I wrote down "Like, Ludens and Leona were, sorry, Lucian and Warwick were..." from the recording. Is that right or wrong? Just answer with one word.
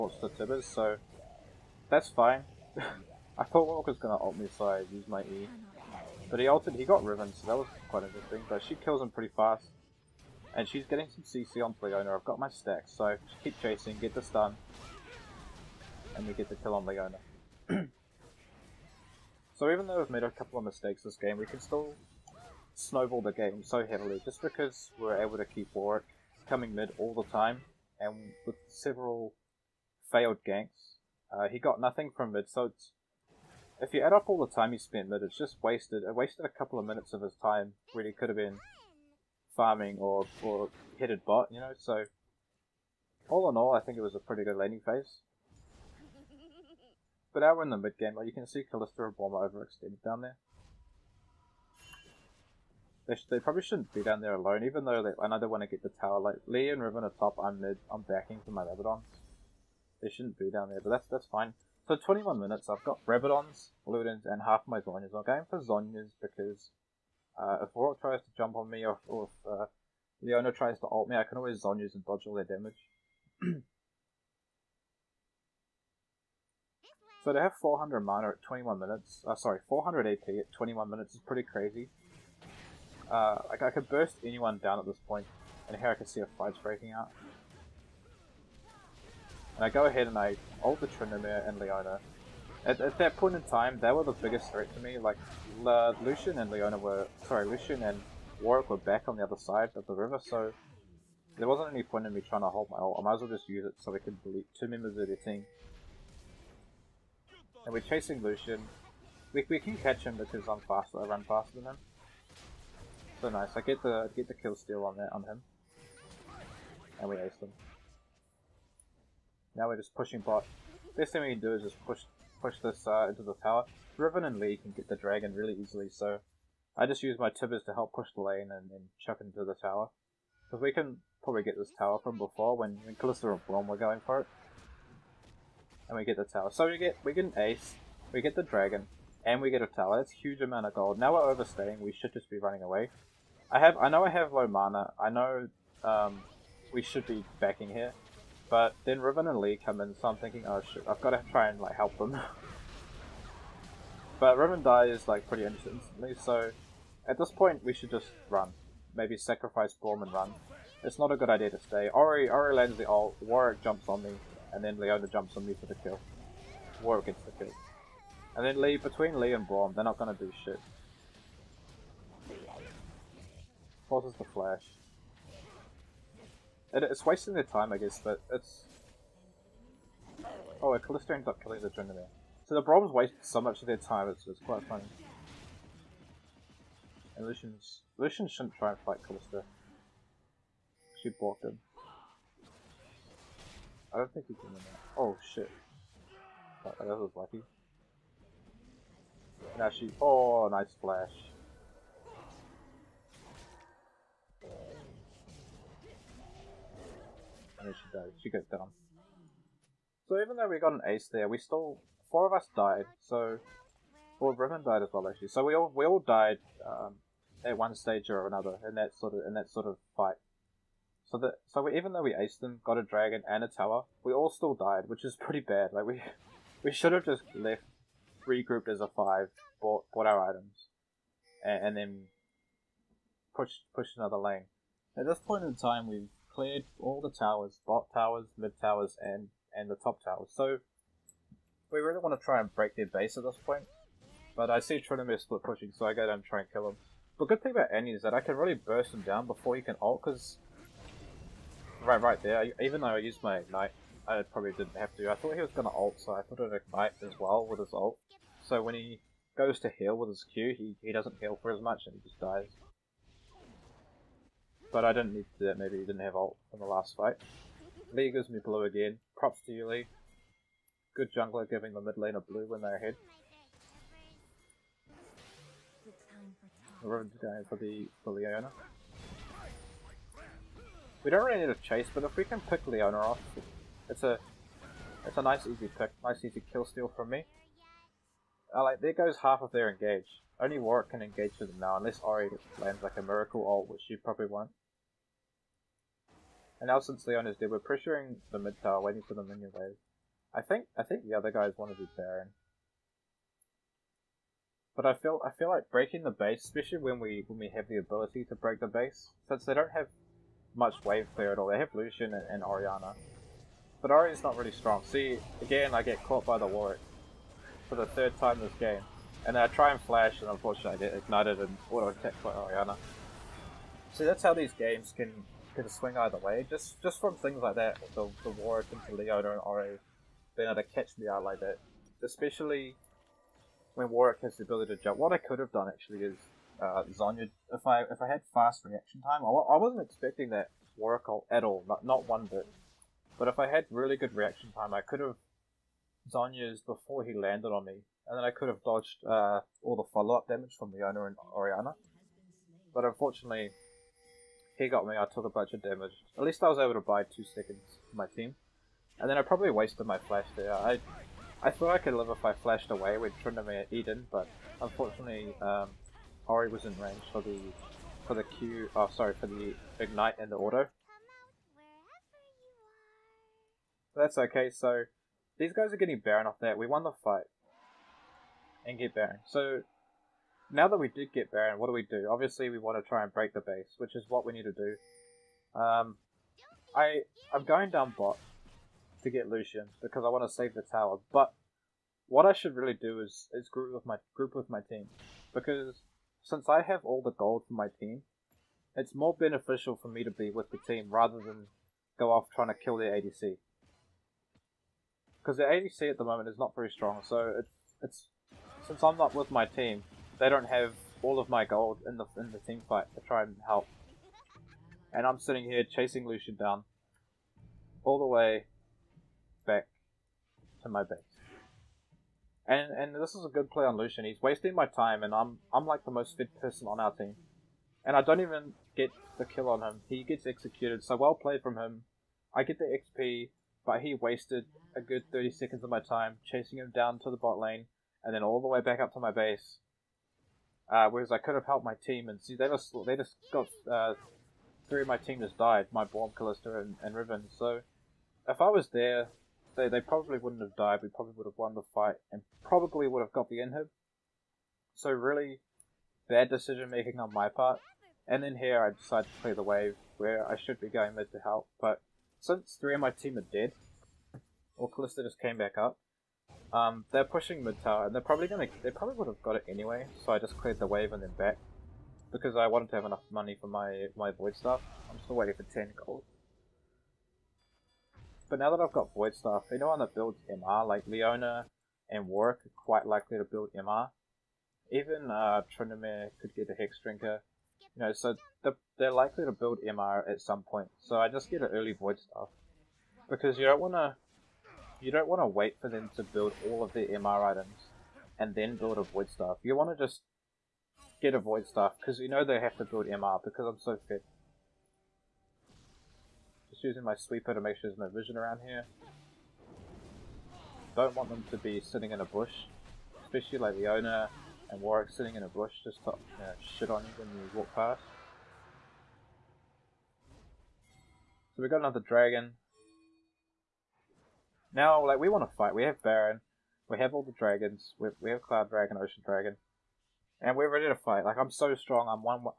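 wrong.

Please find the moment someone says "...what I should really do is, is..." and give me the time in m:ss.
6:32.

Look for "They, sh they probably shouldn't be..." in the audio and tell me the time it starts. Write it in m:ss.
0:53.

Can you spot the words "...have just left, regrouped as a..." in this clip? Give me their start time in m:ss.
3:46.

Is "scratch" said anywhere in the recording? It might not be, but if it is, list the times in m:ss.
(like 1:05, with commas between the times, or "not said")
not said.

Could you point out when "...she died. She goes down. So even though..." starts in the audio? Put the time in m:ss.
3:27.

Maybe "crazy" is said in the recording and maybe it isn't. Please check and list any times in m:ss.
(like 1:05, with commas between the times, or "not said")
1:21.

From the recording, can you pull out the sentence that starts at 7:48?
They probably would have got it anyway.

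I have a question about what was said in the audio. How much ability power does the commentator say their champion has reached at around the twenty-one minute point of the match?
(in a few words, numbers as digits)
400.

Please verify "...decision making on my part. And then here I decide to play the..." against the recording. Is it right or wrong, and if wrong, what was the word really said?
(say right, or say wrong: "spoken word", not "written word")
right.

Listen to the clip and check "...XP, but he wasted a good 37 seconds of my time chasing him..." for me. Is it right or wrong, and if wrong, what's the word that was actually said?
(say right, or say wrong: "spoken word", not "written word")
wrong: "30", not "37".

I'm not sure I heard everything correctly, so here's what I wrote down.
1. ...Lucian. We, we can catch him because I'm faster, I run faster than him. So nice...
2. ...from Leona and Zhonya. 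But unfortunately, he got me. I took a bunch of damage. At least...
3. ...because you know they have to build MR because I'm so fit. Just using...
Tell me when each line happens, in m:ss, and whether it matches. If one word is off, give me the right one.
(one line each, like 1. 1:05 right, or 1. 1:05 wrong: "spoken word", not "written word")
1. 1:48 right
2. 5:50 wrong: "Orianna", not "Zhonya"
3. 8:21 right.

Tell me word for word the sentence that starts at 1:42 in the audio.
I might as well just use it so we can delete two members of their team.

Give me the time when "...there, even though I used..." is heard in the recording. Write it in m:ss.
4:12.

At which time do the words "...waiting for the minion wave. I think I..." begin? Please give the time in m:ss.
4:58.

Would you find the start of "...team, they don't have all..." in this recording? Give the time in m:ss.
6:49.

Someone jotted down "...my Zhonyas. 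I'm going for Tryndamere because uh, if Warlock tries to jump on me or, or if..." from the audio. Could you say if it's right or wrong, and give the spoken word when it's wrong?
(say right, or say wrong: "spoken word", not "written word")
wrong: "Zhonyas", not "Tryndamere".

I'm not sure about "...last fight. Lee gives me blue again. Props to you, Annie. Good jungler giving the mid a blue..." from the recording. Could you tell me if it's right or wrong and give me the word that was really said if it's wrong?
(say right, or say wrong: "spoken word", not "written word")
wrong: "Lee", not "Annie".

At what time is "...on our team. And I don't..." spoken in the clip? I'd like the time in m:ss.
7:06.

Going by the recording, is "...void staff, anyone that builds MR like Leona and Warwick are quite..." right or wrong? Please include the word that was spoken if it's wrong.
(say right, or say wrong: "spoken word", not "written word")
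right.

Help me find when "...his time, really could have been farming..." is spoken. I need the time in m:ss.
0:37.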